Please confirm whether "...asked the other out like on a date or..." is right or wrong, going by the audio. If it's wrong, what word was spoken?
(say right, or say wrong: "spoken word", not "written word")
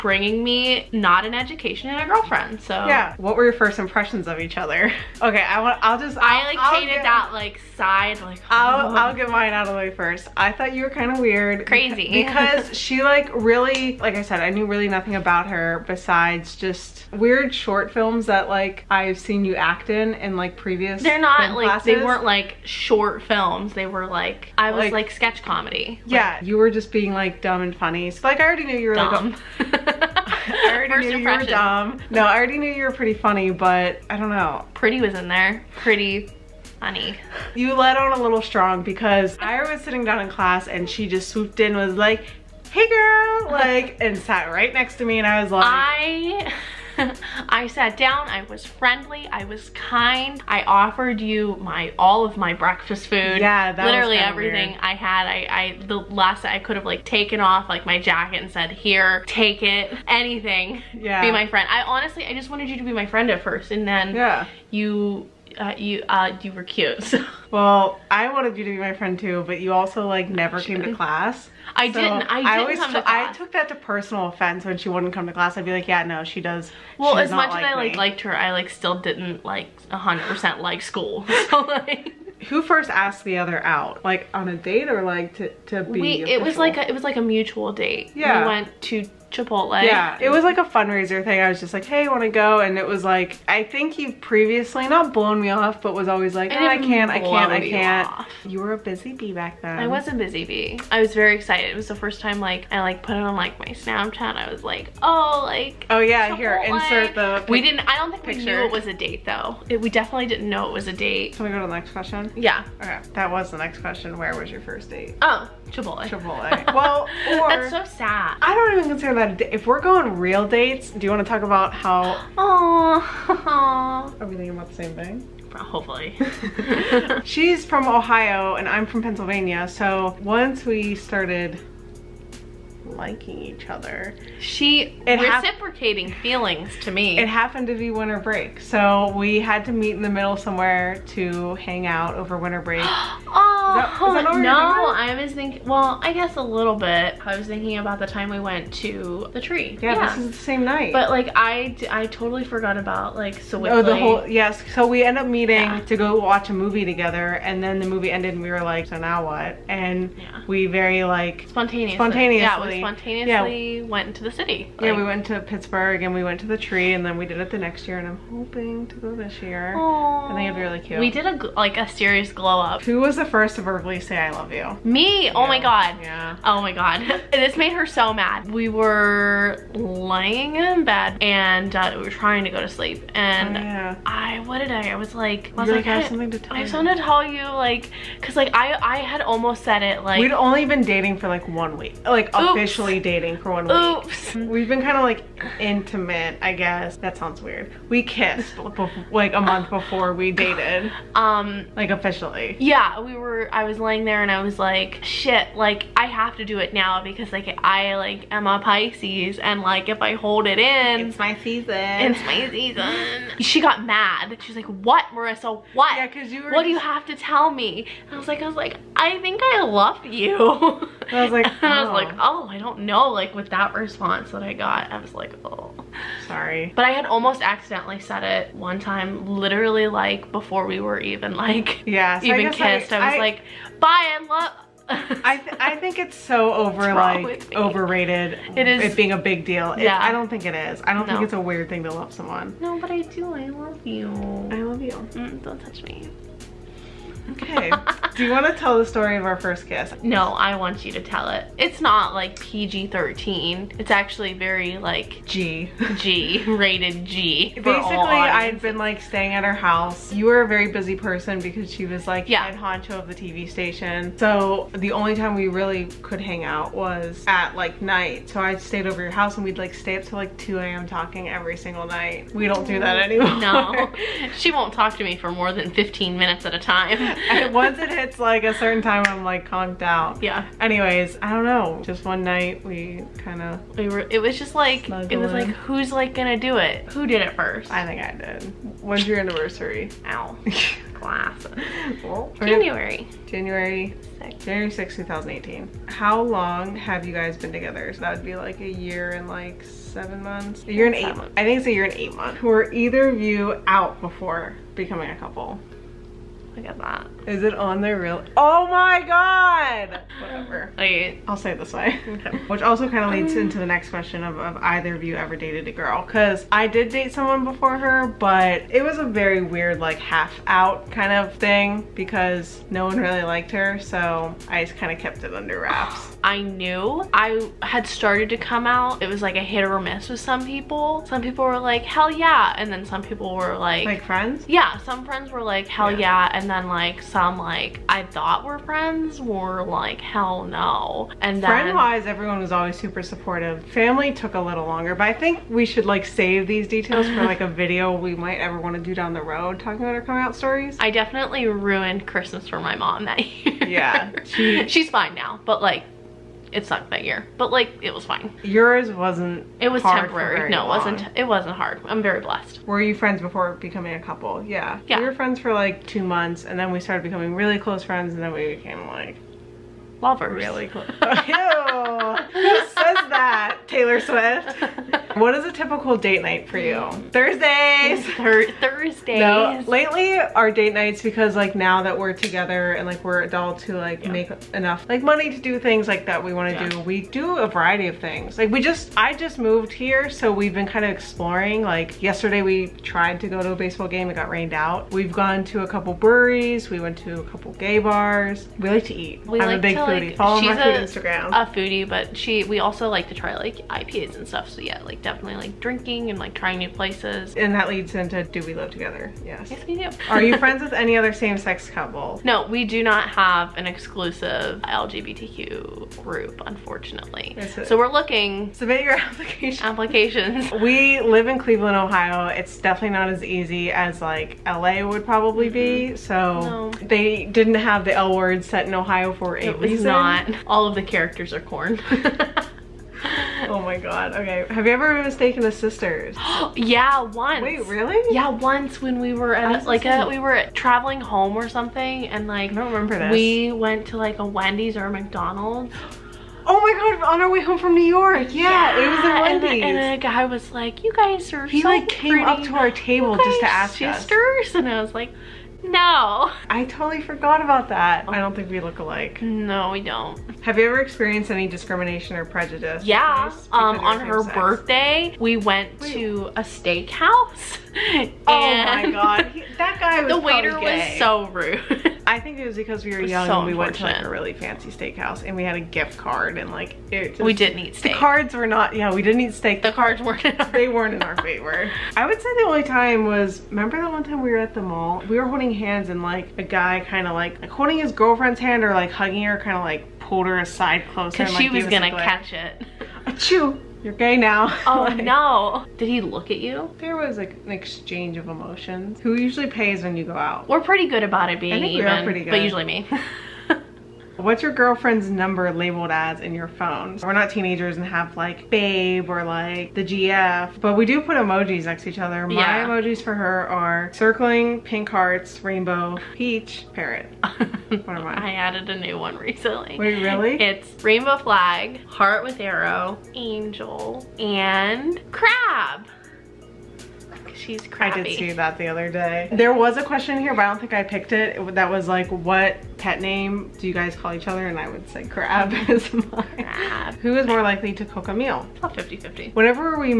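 right.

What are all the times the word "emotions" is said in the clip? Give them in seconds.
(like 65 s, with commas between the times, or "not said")
498 s.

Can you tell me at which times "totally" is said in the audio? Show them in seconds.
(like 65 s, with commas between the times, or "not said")
152 s, 456 s.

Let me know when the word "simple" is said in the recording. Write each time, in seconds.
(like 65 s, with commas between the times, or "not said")
not said.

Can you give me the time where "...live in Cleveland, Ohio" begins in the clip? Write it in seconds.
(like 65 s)
420 s.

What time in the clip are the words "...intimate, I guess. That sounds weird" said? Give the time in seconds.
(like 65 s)
195 s.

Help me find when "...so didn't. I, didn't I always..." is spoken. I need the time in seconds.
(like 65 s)
71 s.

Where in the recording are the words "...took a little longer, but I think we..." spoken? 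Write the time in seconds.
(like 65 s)
344 s.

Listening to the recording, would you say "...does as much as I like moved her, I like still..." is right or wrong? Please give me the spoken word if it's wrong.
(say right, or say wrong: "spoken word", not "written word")
wrong: "liked", not "moved".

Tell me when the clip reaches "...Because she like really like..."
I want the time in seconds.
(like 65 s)
12 s.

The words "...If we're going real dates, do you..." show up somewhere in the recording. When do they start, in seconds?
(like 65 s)
119 s.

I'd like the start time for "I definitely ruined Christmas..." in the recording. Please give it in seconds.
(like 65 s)
350 s.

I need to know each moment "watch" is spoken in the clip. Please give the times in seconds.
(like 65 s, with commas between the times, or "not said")
156 s.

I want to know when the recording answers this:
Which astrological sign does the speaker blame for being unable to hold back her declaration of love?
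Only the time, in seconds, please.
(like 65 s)
207 s.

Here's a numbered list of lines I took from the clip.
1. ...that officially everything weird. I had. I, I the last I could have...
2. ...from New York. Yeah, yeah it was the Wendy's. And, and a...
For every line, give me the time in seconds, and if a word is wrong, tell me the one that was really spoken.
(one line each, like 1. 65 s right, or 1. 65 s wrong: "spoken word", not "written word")
1. 53 s wrong: "literally", not "officially"
2. 447 s right.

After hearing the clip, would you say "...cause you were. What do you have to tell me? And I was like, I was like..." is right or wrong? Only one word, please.
right.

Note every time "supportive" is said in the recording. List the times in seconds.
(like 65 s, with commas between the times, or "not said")
343 s.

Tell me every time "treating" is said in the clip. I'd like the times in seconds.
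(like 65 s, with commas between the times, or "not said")
not said.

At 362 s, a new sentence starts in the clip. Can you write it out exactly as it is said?
Were you friends before becoming a couple?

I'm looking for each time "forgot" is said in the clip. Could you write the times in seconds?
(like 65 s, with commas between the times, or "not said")
152 s, 457 s.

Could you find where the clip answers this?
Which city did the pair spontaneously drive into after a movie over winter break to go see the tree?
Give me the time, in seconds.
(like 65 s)
164 s.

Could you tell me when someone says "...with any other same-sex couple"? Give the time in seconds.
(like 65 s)
410 s.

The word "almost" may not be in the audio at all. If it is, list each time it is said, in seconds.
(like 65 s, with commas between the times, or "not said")
189 s, 227 s.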